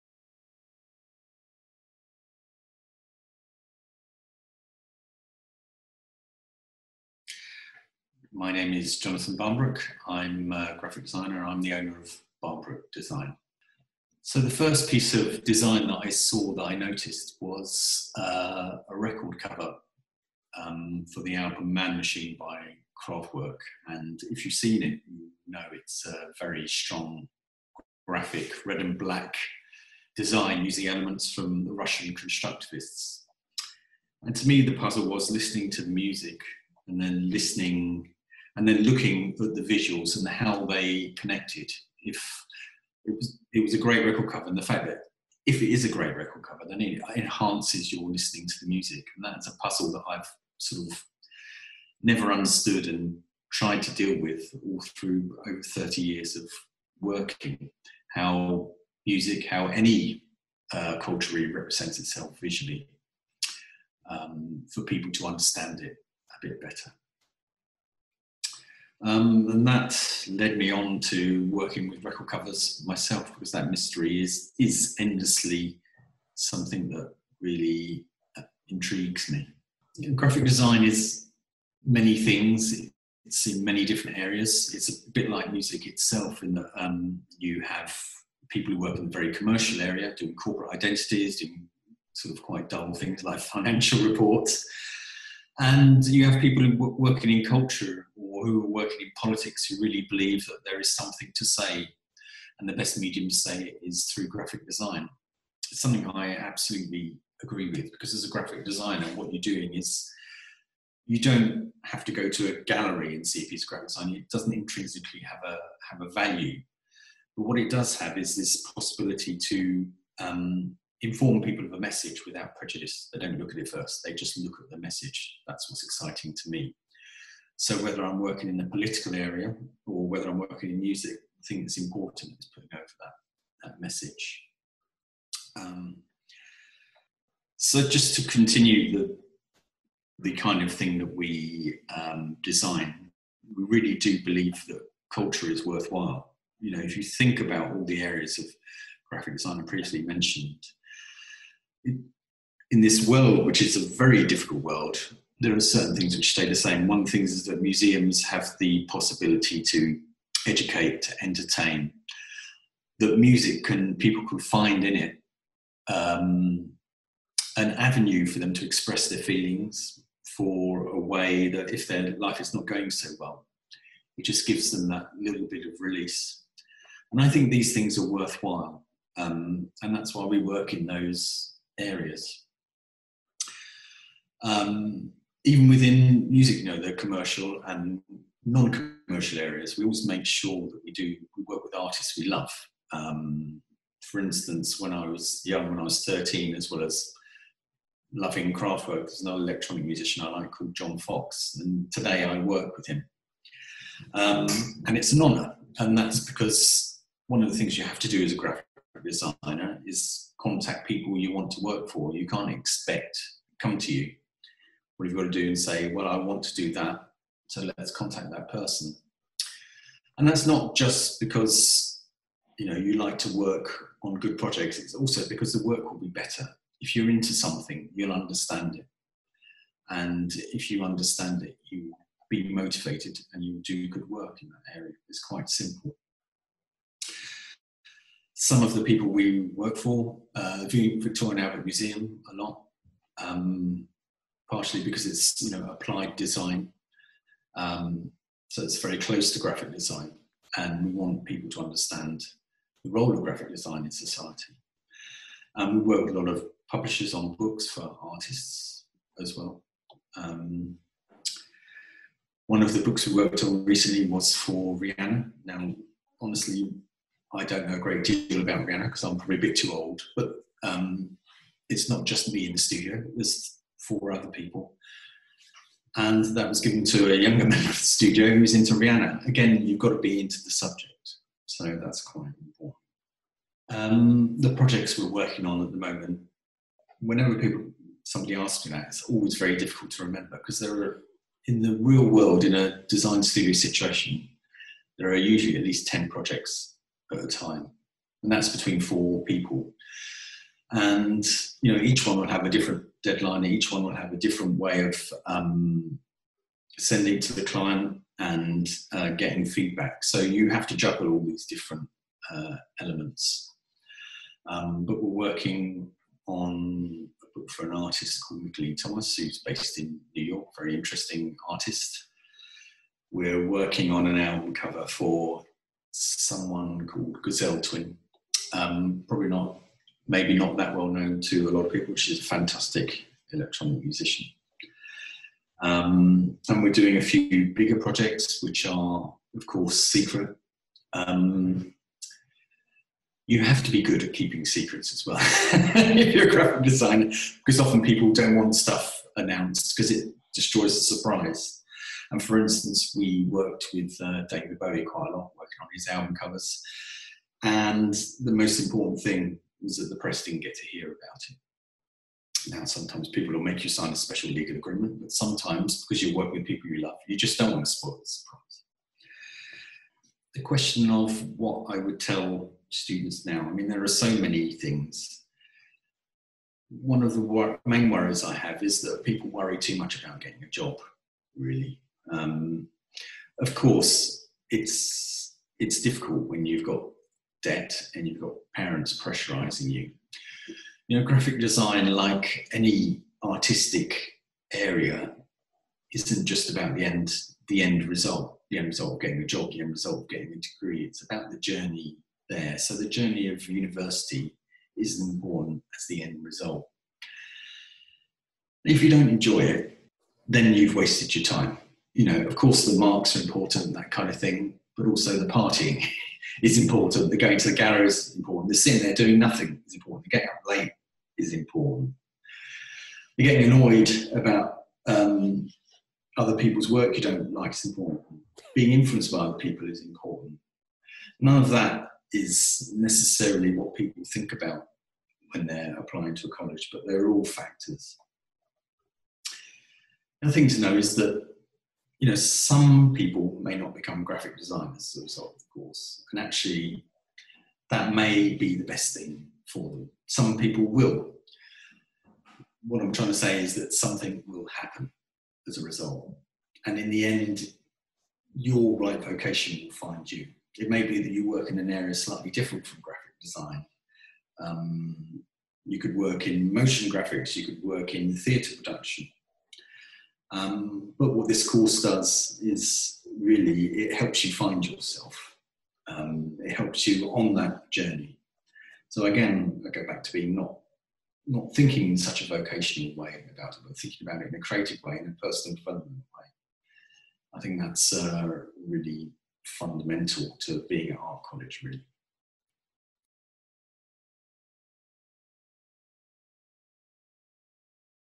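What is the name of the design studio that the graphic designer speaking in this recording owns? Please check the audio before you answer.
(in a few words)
Barnbrook Design.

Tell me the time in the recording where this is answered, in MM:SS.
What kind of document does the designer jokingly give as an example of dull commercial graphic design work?
01:33.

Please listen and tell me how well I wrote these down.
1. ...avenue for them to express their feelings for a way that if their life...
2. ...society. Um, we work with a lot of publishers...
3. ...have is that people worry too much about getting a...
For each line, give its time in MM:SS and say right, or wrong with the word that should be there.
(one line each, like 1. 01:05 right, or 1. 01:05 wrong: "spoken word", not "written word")
1. 02:47 right
2. 04:13 right
3. 06:18 right.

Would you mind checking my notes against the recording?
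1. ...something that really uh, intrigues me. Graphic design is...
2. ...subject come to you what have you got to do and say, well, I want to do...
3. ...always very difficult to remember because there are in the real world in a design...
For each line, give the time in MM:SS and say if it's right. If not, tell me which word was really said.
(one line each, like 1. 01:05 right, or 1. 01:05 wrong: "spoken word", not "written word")
1. 01:16 right
2. 03:32 wrong: "expect", not "subject"
3. 04:49 right.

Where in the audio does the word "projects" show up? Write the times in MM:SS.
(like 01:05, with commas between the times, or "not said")
03:44, 04:44, 04:56, 05:37.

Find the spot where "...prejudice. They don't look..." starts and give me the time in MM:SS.
02:02.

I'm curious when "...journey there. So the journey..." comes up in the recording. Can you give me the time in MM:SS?
06:41.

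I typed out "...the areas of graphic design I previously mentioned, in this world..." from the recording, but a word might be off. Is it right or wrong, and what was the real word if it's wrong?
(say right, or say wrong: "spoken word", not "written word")
right.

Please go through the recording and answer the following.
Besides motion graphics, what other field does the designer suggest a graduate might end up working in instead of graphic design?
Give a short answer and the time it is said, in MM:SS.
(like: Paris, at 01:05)
theatre production, at 07:48.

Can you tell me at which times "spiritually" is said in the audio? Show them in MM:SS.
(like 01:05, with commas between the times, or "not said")
not said.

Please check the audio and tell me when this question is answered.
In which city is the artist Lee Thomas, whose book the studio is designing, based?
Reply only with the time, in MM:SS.
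05:20.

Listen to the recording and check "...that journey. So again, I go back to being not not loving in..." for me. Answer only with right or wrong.
wrong.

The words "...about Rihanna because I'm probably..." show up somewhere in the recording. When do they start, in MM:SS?
04:28.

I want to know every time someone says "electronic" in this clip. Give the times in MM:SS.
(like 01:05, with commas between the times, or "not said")
03:19, 05:33.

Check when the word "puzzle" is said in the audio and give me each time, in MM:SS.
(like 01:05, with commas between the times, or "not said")
00:34, 00:49.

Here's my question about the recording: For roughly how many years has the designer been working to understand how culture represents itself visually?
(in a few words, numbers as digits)
over 30 years.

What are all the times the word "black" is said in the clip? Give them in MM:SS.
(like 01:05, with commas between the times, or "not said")
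00:28.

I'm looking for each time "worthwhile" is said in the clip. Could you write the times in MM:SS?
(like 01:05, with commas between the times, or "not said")
02:25, 02:58.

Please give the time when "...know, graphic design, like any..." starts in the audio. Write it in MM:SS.
06:30.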